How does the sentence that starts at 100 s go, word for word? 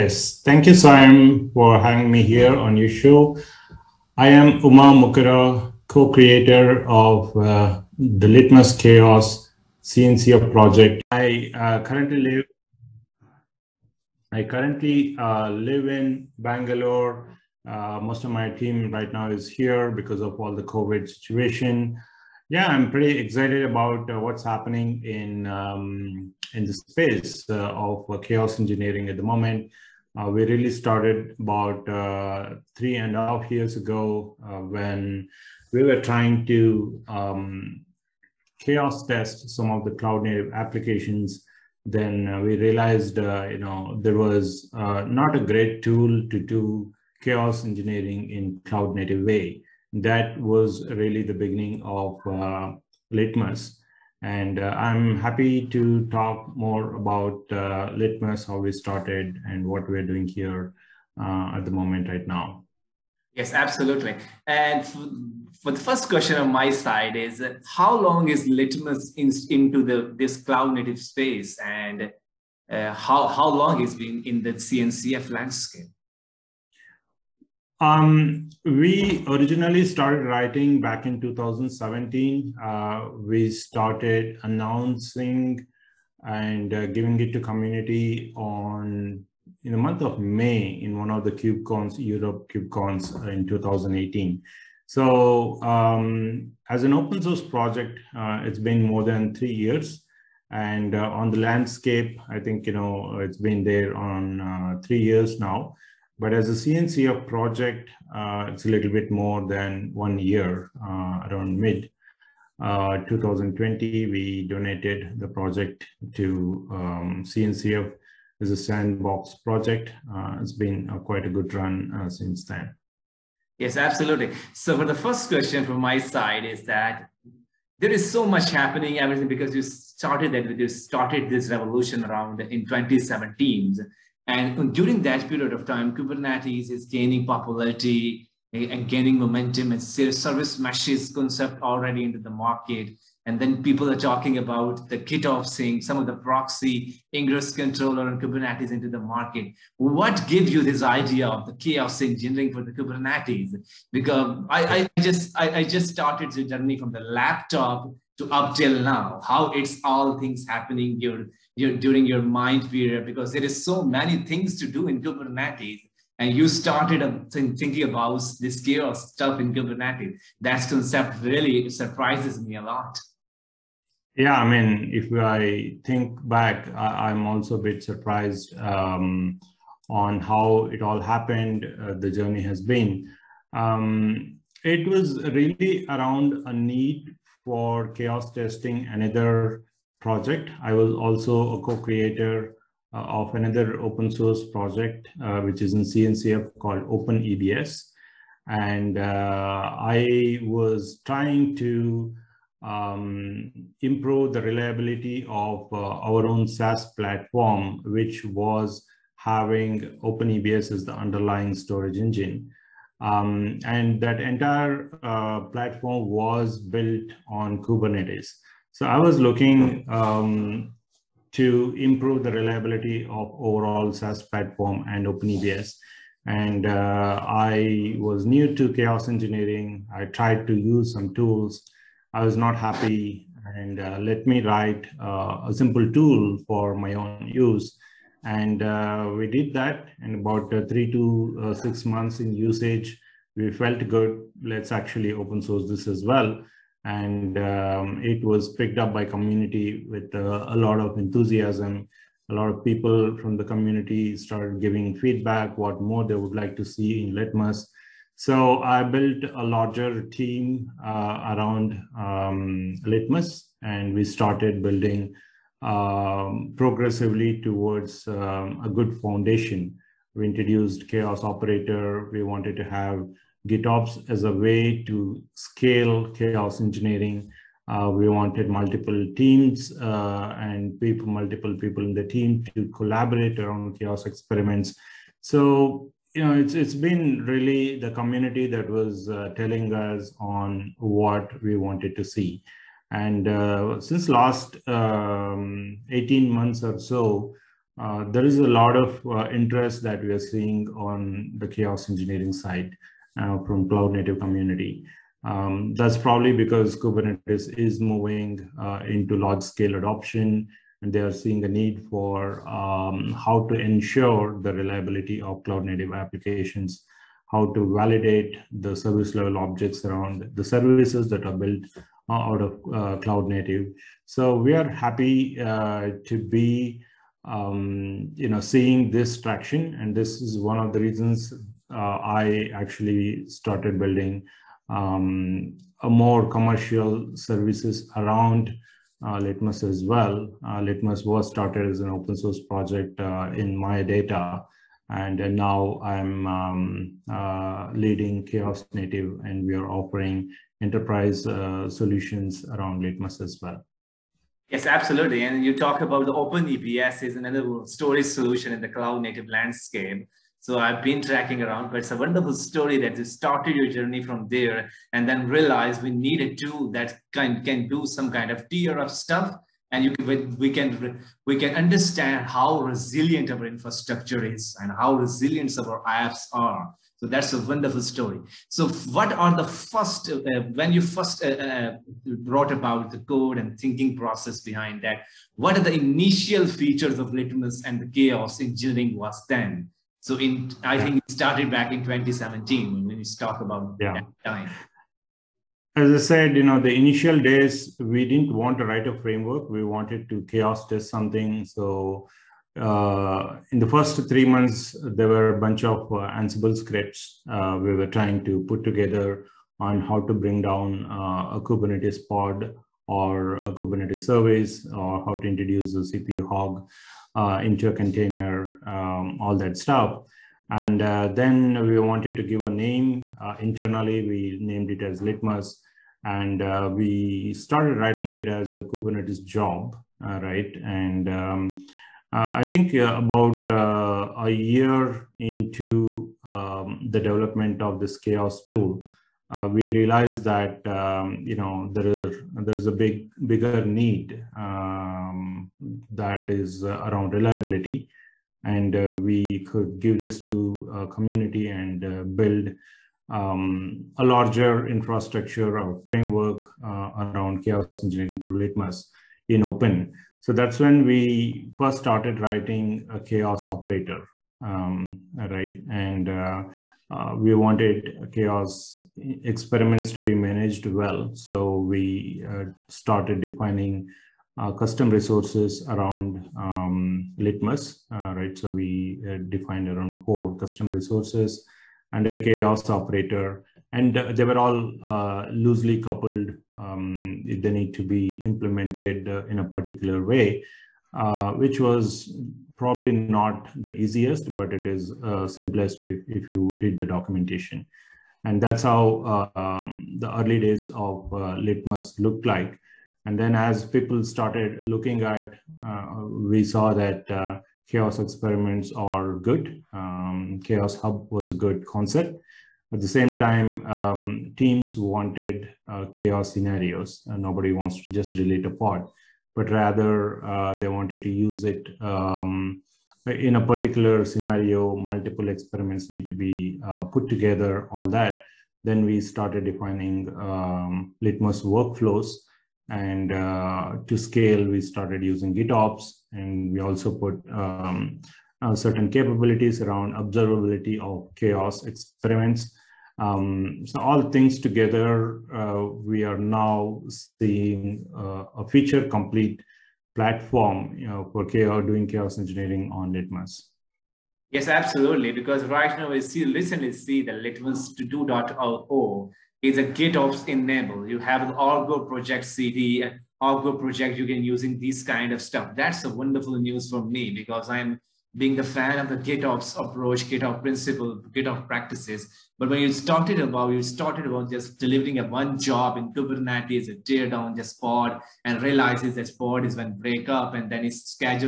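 And uh, on the landscape, I think, you know, it's been there on uh, three years now.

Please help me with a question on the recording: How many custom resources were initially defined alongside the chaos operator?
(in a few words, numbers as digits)
4.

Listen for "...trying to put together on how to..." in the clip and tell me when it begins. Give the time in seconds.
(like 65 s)
407 s.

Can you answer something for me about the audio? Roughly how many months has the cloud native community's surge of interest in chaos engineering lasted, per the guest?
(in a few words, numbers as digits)
18.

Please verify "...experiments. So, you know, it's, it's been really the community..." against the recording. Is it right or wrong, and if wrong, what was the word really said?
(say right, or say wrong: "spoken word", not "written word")
right.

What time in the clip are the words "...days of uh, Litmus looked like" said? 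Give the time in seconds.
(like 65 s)
500 s.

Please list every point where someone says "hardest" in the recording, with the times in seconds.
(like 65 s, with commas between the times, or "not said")
not said.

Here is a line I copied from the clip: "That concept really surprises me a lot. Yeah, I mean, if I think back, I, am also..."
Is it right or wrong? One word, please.
right.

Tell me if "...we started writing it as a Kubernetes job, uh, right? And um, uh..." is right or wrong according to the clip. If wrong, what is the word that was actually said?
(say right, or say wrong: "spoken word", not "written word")
right.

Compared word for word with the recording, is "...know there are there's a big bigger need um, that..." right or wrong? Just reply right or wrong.
right.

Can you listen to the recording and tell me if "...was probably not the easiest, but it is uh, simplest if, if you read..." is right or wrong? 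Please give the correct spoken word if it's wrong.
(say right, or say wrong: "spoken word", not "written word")
right.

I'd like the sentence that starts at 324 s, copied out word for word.
So we are happy uh, to be um, you know, seeing this traction.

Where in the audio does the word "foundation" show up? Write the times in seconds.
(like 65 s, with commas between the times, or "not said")
269 s.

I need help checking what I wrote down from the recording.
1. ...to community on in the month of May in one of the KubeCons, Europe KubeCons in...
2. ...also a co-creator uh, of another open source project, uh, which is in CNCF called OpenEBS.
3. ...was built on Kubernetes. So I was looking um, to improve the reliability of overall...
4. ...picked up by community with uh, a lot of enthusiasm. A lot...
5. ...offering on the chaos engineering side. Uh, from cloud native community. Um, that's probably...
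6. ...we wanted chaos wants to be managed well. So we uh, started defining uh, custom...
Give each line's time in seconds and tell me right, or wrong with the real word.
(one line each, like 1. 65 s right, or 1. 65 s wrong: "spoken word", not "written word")
1. 87 s right
2. 190 s right
3. 216 s right
4. 248 s right
5. 300 s wrong: "seeing", not "offering"
6. 467 s wrong: "experiments", not "wants".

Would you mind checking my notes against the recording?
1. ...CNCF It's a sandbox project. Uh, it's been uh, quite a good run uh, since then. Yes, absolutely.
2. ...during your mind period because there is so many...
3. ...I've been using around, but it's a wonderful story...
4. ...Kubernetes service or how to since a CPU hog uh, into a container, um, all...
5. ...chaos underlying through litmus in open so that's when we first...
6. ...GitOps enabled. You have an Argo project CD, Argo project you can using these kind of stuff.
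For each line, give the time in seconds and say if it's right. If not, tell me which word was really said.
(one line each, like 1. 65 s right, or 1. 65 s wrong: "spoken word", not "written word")
1. 117 s right
2. 161 s right
3. 360 s wrong: "tracking", not "using"
4. 413 s wrong: "introduce", not "since"
5. 457 s wrong: "engineering", not "underlying"
6. 559 s right.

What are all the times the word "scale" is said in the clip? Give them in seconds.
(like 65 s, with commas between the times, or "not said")
275 s, 309 s, 533 s.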